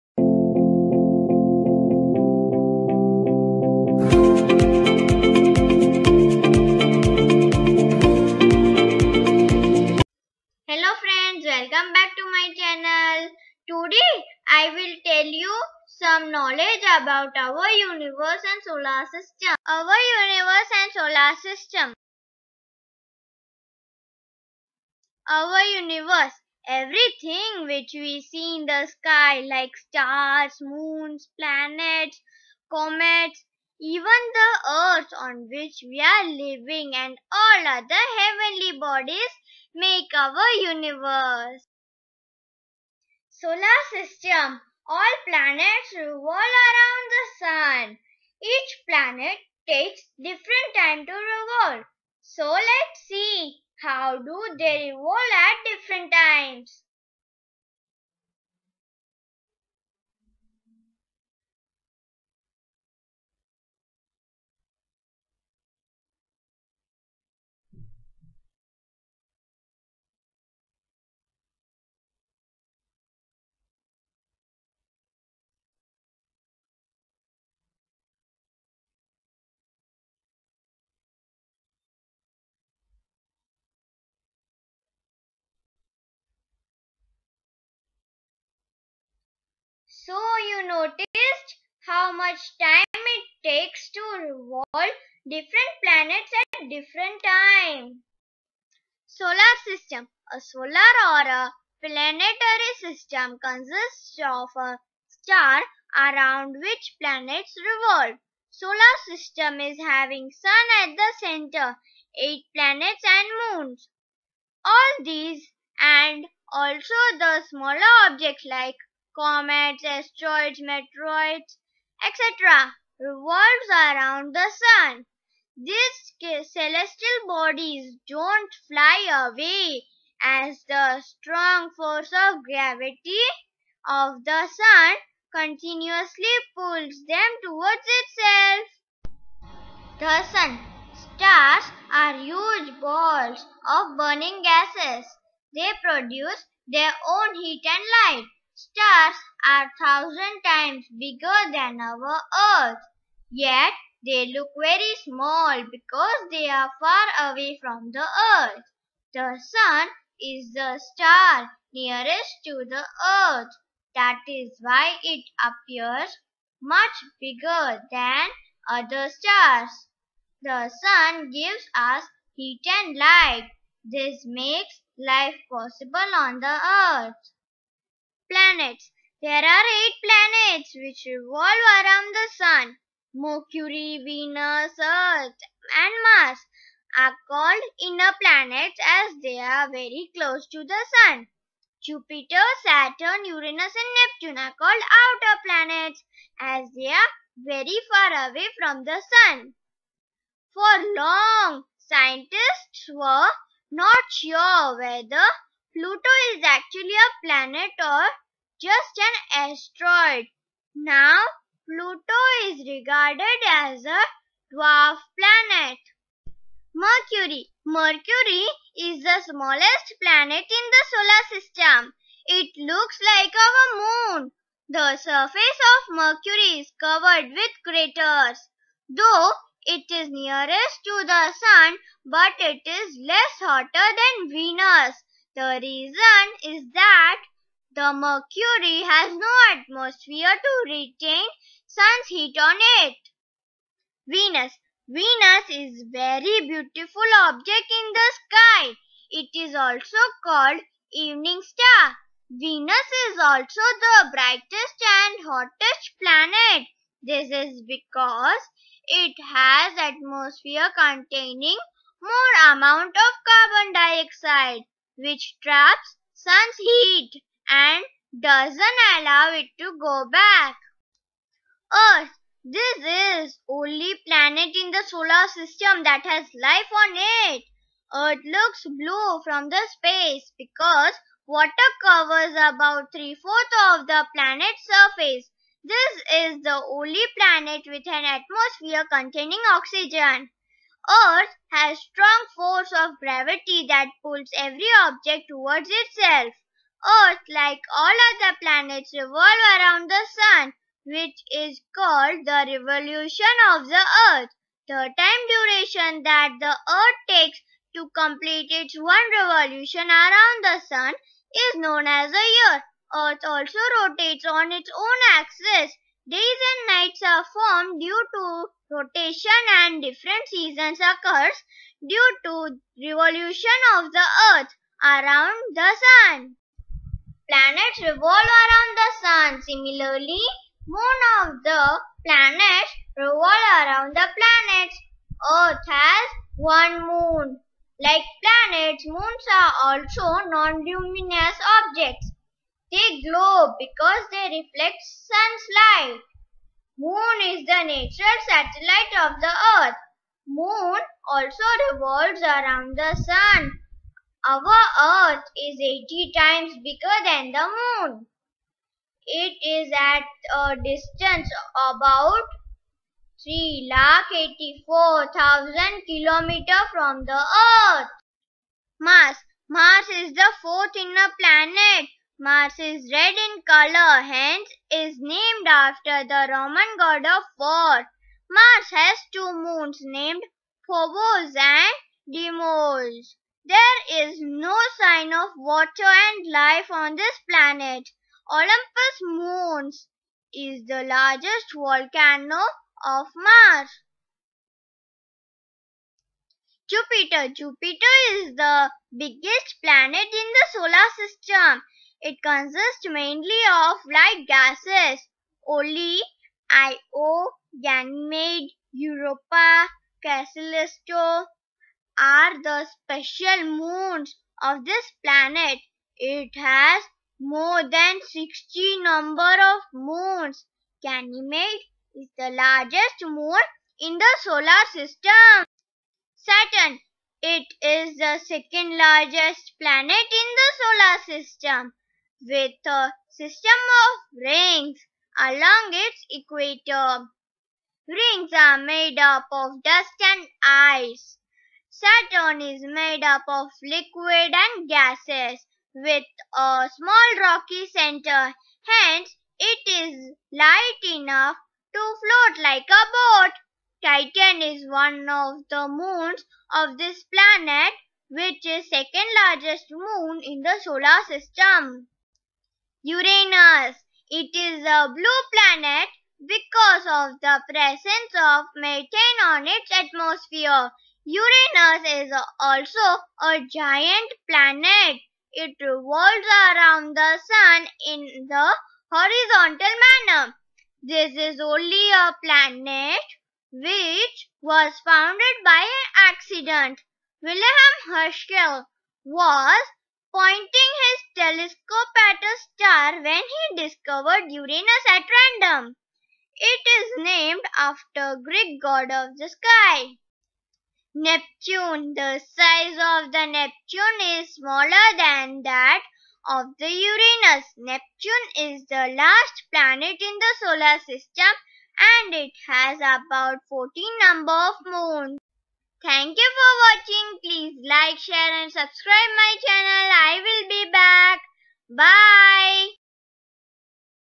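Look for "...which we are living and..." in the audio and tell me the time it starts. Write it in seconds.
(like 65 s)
35 s.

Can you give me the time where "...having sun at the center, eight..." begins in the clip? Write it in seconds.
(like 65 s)
109 s.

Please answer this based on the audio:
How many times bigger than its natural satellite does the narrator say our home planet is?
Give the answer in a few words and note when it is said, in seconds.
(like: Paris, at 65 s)
80, at 355 s.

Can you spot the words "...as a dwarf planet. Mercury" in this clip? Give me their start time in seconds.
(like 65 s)
213 s.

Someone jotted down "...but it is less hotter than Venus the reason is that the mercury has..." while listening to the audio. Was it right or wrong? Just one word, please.
right.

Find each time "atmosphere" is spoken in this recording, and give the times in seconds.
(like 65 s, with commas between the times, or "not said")
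239 s, 259 s, 288 s, 469 s.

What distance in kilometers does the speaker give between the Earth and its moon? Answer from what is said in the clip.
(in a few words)
384,000 kilometers.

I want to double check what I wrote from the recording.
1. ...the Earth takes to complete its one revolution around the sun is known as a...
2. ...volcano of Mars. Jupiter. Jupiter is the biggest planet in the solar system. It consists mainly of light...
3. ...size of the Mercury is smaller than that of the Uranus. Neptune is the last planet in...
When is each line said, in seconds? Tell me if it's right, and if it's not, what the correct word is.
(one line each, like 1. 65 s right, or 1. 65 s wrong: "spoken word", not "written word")
1. 306 s right
2. 391 s right
3. 502 s wrong: "Neptune", not "Mercury".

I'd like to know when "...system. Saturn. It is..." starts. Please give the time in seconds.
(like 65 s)
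424 s.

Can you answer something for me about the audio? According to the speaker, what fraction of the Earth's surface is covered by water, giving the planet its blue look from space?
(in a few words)
three-fourths.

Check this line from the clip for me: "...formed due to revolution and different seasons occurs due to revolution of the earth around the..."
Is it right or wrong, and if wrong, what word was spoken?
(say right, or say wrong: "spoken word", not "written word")
wrong: "rotation", not "revolution".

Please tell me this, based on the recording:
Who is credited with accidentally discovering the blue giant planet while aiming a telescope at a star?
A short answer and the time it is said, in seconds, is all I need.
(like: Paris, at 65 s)
Wilhelm Herschel, at 487 s.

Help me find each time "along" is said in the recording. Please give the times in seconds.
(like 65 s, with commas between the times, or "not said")
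435 s.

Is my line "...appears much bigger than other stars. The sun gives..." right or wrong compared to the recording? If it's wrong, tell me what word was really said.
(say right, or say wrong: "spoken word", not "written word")
right.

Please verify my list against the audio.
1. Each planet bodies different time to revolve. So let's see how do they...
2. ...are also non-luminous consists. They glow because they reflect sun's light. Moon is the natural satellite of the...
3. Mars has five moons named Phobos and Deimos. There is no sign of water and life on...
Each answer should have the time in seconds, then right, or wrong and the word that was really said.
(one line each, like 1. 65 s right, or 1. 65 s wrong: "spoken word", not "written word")
1. 48 s wrong: "takes", not "bodies"
2. 339 s wrong: "objects", not "consists"
3. 378 s wrong: "two", not "five".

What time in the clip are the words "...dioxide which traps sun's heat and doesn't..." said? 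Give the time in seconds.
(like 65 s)
263 s.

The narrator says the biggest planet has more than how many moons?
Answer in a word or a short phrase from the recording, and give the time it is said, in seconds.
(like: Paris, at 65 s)
60, at 417 s.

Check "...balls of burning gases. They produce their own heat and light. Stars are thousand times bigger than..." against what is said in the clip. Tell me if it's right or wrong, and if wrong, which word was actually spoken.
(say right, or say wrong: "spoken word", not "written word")
right.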